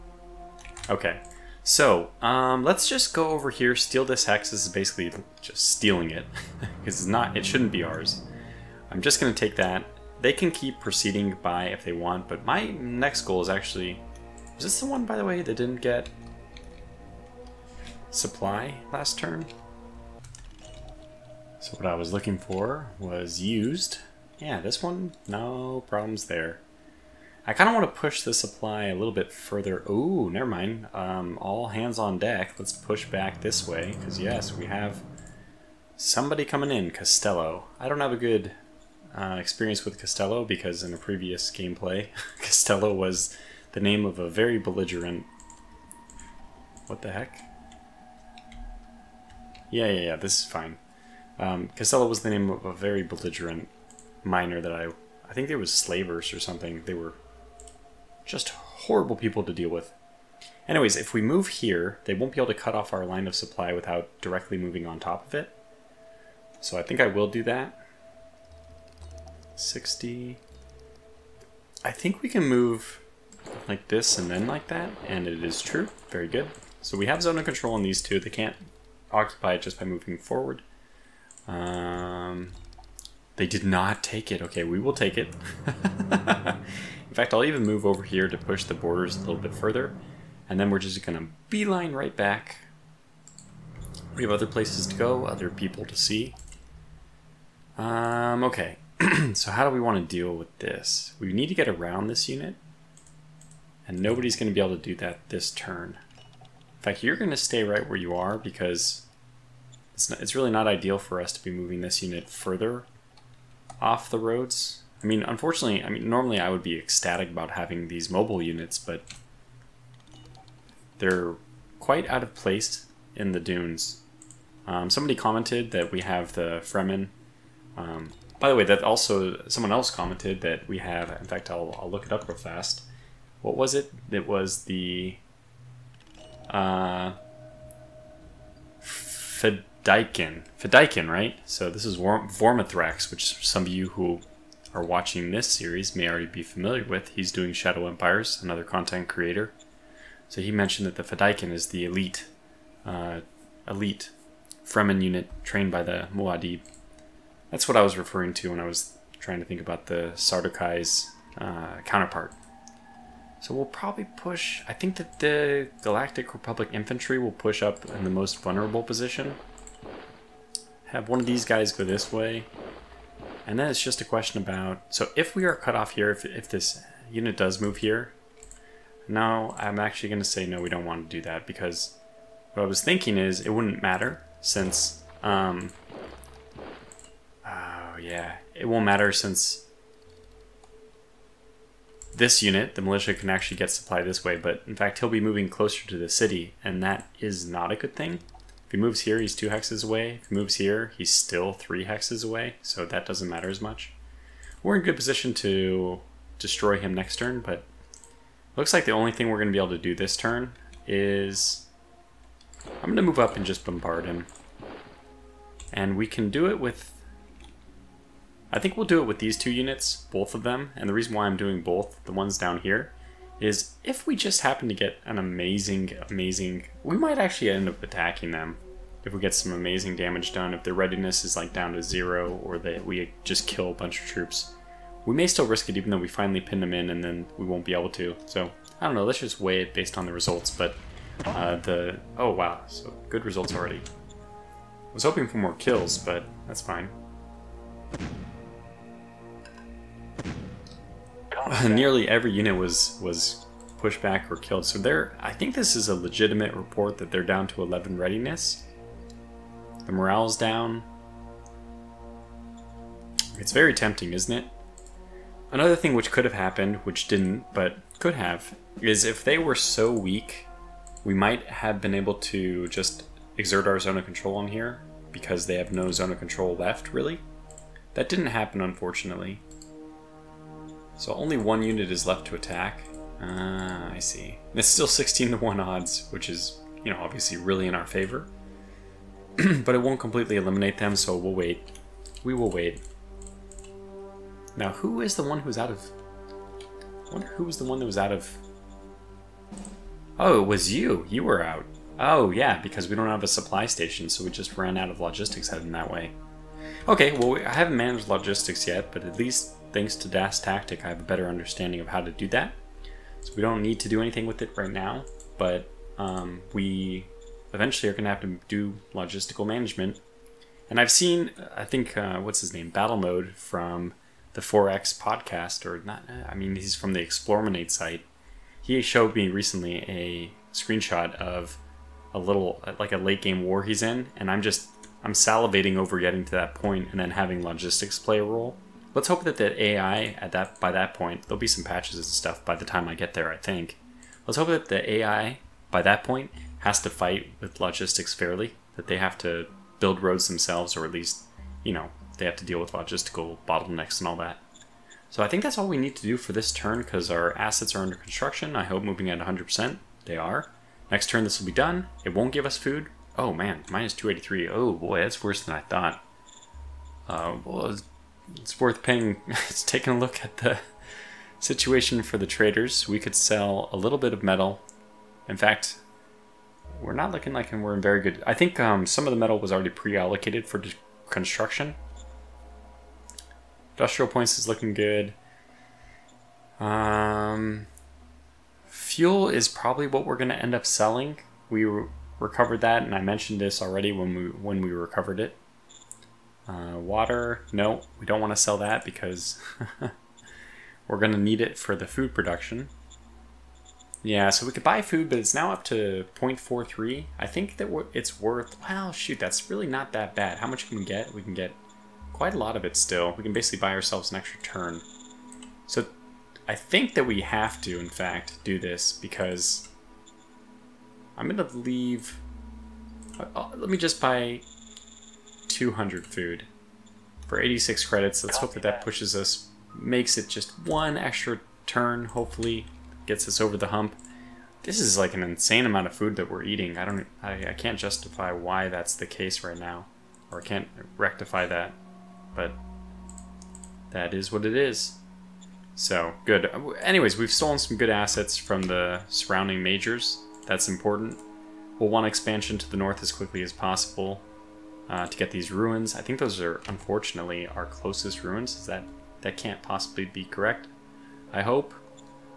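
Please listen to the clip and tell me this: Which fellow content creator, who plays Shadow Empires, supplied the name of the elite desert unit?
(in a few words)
Vormithrax.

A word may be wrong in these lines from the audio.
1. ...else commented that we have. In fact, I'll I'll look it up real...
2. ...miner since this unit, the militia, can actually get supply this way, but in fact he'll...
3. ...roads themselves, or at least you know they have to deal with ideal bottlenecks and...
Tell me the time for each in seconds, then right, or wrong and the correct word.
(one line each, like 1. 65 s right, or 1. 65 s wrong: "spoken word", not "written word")
1. 129 s right
2. 188 s wrong: "matter", not "miner"
3. 350 s wrong: "logistical", not "ideal".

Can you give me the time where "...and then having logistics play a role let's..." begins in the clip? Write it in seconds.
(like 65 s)
336 s.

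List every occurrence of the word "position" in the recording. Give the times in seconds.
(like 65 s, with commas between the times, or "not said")
168 s, 204 s.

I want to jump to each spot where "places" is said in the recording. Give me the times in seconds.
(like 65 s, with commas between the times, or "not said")
94 s, 122 s.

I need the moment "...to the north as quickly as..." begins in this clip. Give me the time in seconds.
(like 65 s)
452 s.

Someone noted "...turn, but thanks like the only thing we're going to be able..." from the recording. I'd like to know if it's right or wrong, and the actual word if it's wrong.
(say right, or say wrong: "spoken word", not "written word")
wrong: "looks", not "thanks".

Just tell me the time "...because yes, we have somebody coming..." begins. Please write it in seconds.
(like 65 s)
33 s.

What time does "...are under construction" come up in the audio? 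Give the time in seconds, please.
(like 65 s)
357 s.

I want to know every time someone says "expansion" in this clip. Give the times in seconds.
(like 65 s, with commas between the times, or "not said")
452 s.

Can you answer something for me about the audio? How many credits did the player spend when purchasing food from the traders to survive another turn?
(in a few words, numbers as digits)
86.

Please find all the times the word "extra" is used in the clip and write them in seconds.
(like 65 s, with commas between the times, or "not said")
414 s, 430 s.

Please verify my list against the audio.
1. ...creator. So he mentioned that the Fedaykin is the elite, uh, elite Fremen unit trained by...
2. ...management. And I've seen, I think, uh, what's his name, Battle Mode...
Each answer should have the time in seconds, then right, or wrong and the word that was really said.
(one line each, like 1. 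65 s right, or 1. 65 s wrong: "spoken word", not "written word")
1. 149 s right
2. 319 s right.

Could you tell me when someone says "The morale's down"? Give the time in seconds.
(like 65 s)
259 s.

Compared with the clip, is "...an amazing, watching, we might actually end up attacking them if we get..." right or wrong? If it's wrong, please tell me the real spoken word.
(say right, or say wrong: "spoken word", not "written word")
wrong: "amazing", not "watching".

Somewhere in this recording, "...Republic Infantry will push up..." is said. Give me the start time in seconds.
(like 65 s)
166 s.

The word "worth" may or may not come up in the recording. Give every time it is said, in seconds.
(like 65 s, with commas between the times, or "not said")
368 s, 408 s.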